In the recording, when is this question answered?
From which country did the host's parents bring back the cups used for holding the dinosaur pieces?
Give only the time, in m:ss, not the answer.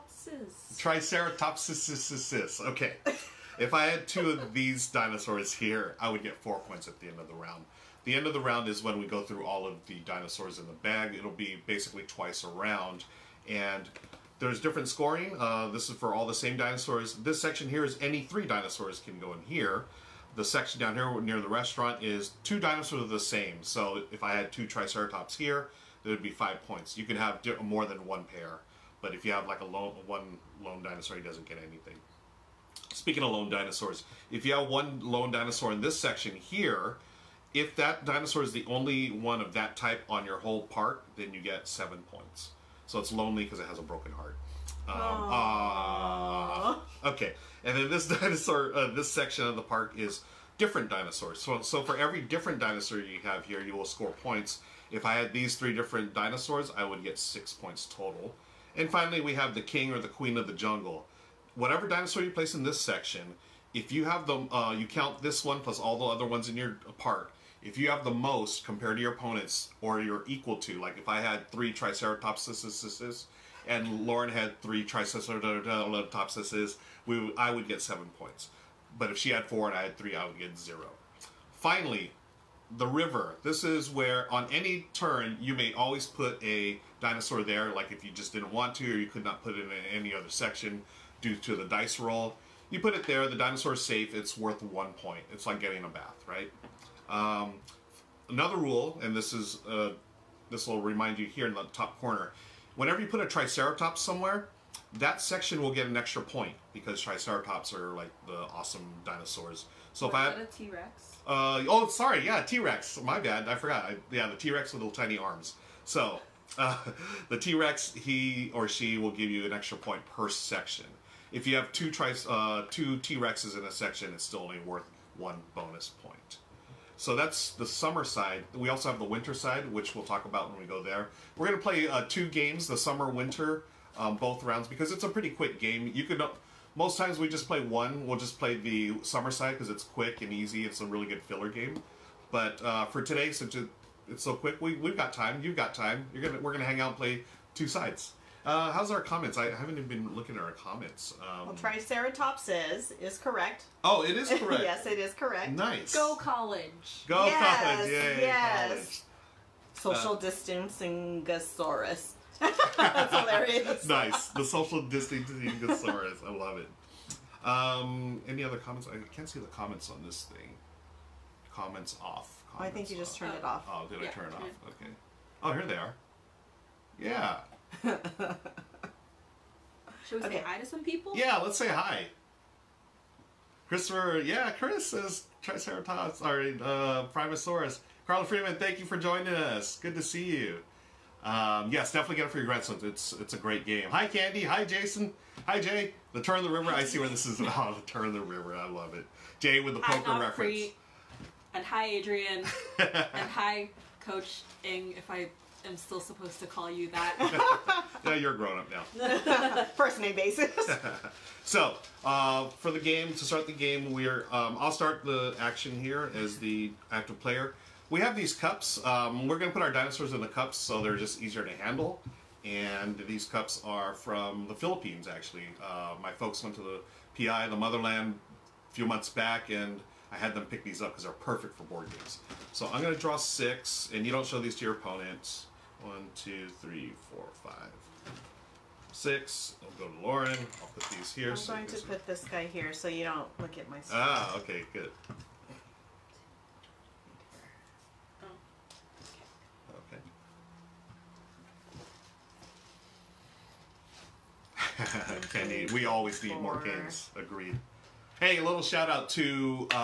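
3:44.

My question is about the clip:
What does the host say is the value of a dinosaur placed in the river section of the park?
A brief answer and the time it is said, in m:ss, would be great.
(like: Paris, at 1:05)
1 point, at 1:34.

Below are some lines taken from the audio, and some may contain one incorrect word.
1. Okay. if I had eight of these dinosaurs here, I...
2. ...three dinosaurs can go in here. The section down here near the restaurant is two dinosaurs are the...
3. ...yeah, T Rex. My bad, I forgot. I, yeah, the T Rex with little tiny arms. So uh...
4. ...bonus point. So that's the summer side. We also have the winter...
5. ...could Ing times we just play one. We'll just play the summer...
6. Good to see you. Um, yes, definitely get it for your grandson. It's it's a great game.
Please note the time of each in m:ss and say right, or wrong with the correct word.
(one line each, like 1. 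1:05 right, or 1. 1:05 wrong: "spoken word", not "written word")
1. 0:02 wrong: "two", not "eight"
2. 0:18 right
3. 1:52 right
4. 2:05 right
5. 2:16 wrong: "Most", not "Ing"
6. 3:09 right.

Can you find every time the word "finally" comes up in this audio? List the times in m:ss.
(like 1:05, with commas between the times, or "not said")
0:58, 1:21.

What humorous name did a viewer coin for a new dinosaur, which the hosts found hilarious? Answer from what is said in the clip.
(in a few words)
Social distancing gasaurus.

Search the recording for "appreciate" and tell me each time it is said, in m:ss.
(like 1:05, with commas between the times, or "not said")
not said.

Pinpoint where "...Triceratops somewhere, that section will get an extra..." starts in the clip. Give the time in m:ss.
1:43.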